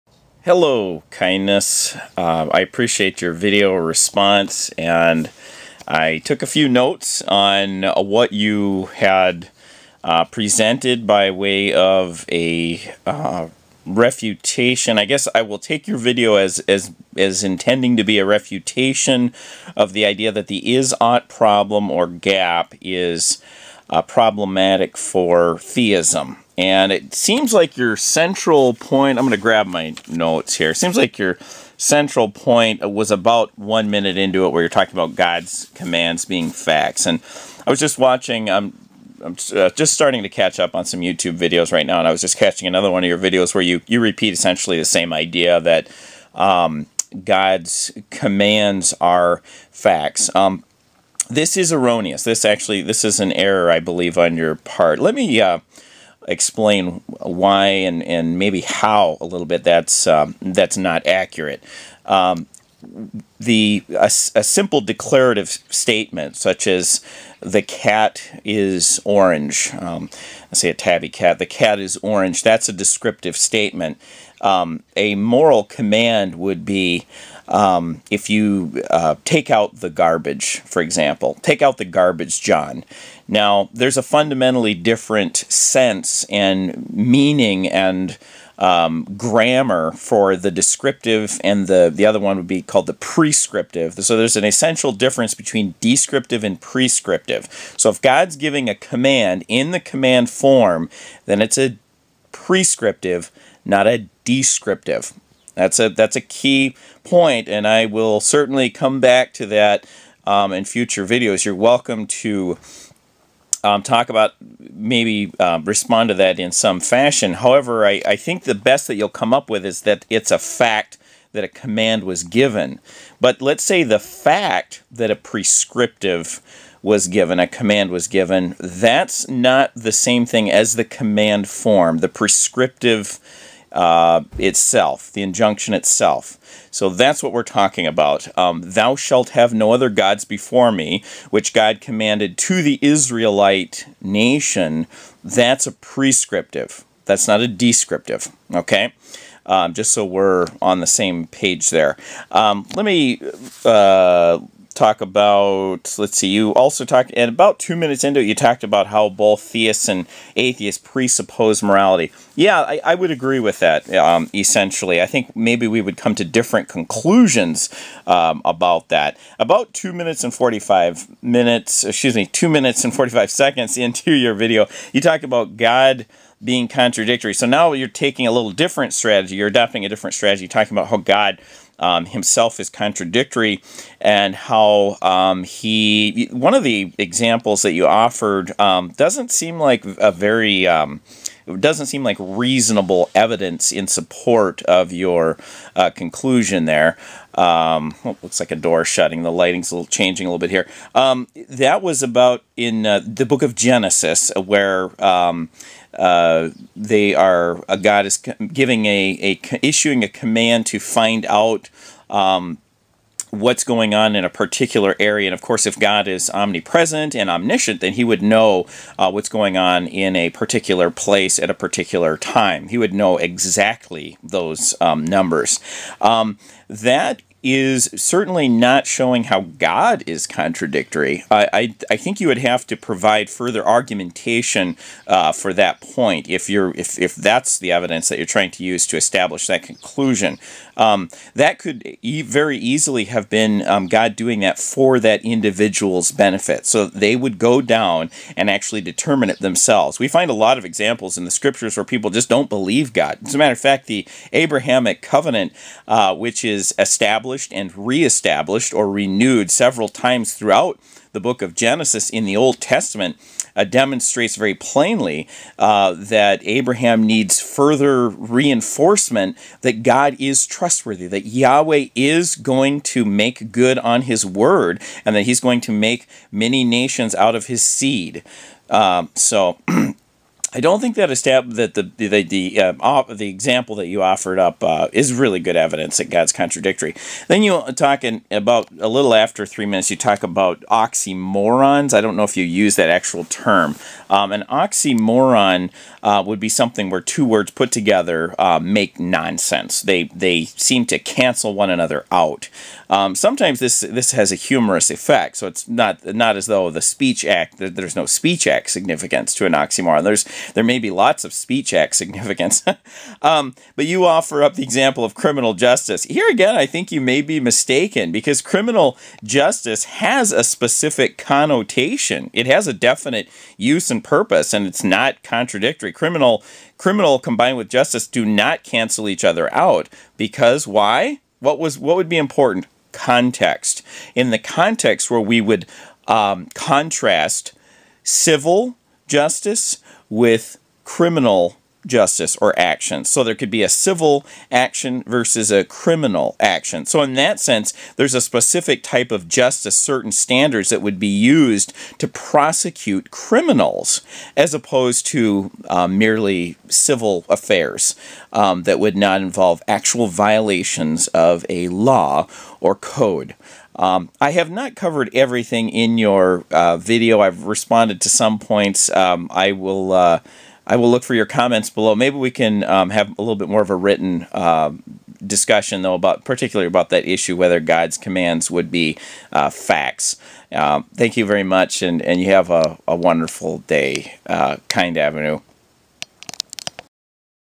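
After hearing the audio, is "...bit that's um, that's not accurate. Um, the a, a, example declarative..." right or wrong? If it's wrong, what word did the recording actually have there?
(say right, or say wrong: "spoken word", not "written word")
wrong: "simple", not "example".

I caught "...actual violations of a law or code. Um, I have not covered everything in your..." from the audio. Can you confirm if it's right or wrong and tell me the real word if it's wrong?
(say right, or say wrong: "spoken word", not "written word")
right.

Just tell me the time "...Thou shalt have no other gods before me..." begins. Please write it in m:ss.
2:18.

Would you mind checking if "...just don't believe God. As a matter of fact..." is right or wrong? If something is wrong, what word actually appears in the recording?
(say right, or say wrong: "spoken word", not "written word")
right.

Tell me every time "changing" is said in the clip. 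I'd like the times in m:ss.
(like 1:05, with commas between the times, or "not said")
3:19.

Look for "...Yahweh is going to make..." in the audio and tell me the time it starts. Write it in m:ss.
4:31.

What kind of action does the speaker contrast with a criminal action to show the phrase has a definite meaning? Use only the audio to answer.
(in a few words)
civil action.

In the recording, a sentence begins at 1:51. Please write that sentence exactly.
You're welcome to um, talk about maybe uh, respond to that in some fashion.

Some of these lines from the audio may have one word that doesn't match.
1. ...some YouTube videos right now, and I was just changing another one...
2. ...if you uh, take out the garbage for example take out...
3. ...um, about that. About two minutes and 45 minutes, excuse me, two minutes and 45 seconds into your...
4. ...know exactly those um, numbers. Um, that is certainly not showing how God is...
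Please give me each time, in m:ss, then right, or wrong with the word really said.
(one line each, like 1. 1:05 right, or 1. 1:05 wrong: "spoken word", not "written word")
1. 0:40 wrong: "catching", not "changing"
2. 1:18 right
3. 2:48 right
4. 3:42 right.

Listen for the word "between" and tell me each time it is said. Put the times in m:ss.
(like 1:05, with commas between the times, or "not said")
1:35.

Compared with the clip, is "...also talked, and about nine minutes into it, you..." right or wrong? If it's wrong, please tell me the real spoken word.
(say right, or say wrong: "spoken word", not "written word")
wrong: "two", not "nine".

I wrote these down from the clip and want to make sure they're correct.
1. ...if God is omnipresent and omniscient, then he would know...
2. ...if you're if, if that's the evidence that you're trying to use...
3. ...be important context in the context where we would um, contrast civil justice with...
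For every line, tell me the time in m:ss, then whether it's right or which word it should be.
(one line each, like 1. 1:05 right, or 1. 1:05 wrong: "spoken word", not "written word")
1. 3:35 right
2. 3:56 right
3. 5:32 right.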